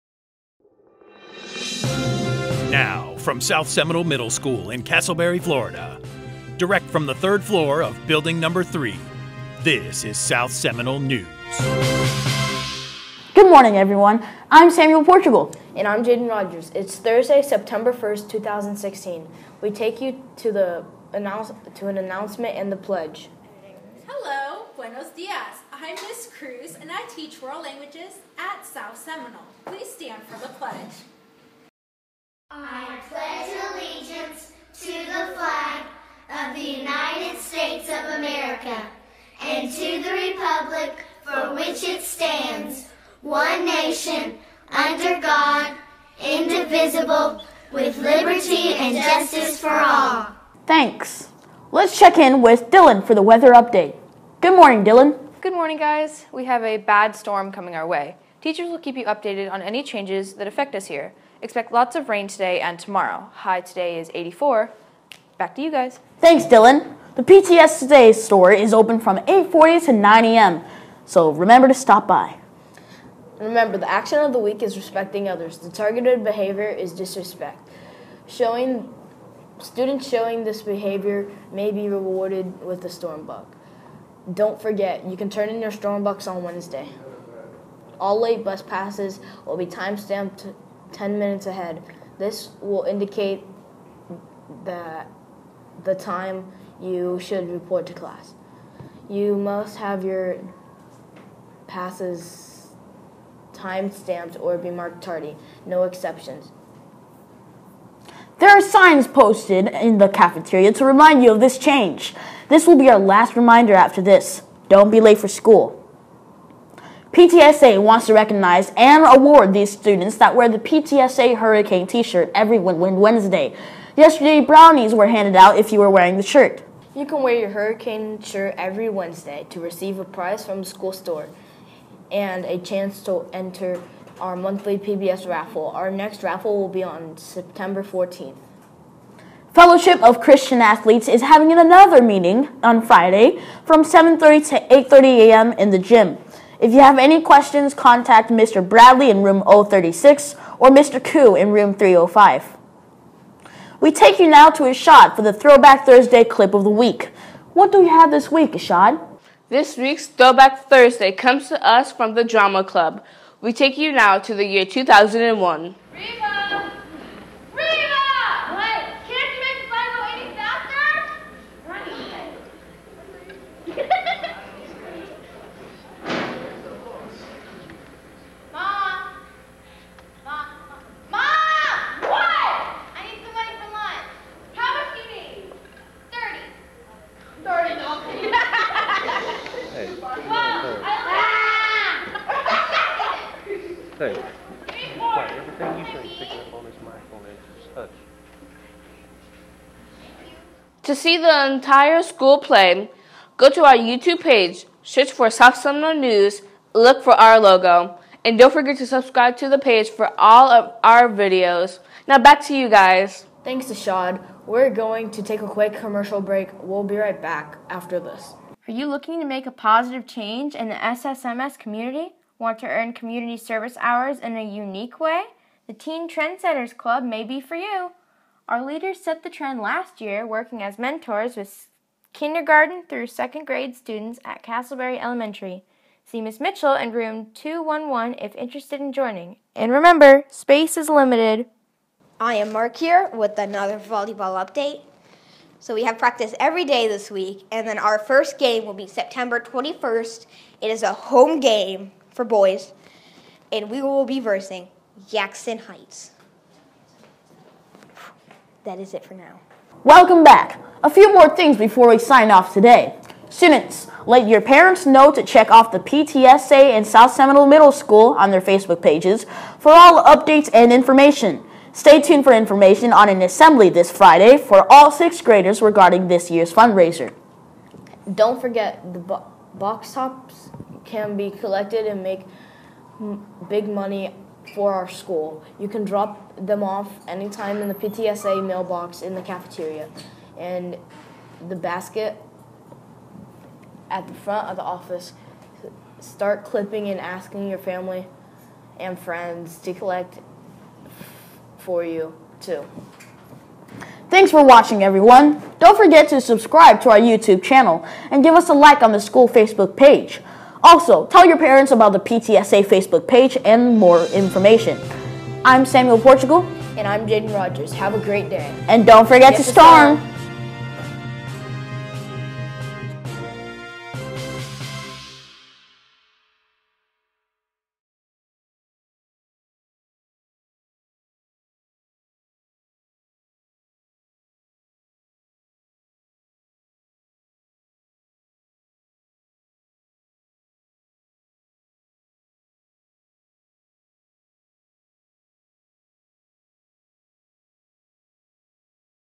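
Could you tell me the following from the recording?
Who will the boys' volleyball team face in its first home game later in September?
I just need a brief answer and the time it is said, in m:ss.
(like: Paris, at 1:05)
Jackson Heights, at 4:15.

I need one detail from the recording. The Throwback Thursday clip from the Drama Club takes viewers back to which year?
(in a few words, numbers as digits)
2001.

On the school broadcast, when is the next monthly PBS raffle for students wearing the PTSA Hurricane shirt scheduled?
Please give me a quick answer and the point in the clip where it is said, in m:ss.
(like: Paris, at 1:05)
September 14th, at 2:17.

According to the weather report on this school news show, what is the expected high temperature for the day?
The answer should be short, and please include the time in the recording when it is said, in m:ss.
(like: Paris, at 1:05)
84, at 1:04.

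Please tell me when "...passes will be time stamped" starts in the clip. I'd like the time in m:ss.
1:28.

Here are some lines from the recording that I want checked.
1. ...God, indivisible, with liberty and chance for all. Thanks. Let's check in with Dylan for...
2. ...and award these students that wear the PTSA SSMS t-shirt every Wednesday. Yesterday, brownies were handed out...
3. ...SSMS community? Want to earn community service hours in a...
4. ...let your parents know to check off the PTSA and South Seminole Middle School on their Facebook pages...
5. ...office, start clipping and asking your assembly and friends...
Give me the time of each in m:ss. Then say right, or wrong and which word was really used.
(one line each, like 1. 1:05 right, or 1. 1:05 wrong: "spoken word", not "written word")
1. 0:45 wrong: "justice", not "chance"
2. 1:58 wrong: "Hurricane", not "SSMS"
3. 3:40 right
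4. 4:24 right
5. 4:54 wrong: "family", not "assembly".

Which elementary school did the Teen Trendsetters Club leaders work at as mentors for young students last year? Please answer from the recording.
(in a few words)
Casselberry Elementary.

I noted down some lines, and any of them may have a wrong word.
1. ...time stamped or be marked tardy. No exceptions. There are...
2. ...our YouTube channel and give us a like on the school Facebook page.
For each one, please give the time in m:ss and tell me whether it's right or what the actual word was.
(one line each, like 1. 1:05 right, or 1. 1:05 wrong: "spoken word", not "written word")
1. 1:43 right
2. 5:06 right.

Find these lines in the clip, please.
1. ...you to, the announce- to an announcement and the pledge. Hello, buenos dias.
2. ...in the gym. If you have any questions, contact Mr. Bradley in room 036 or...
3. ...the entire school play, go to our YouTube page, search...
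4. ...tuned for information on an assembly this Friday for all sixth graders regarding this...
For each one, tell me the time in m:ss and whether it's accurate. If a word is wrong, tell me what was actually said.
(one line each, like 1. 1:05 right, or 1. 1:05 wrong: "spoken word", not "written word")
1. 0:20 right
2. 2:25 right
3. 3:21 right
4. 4:32 right.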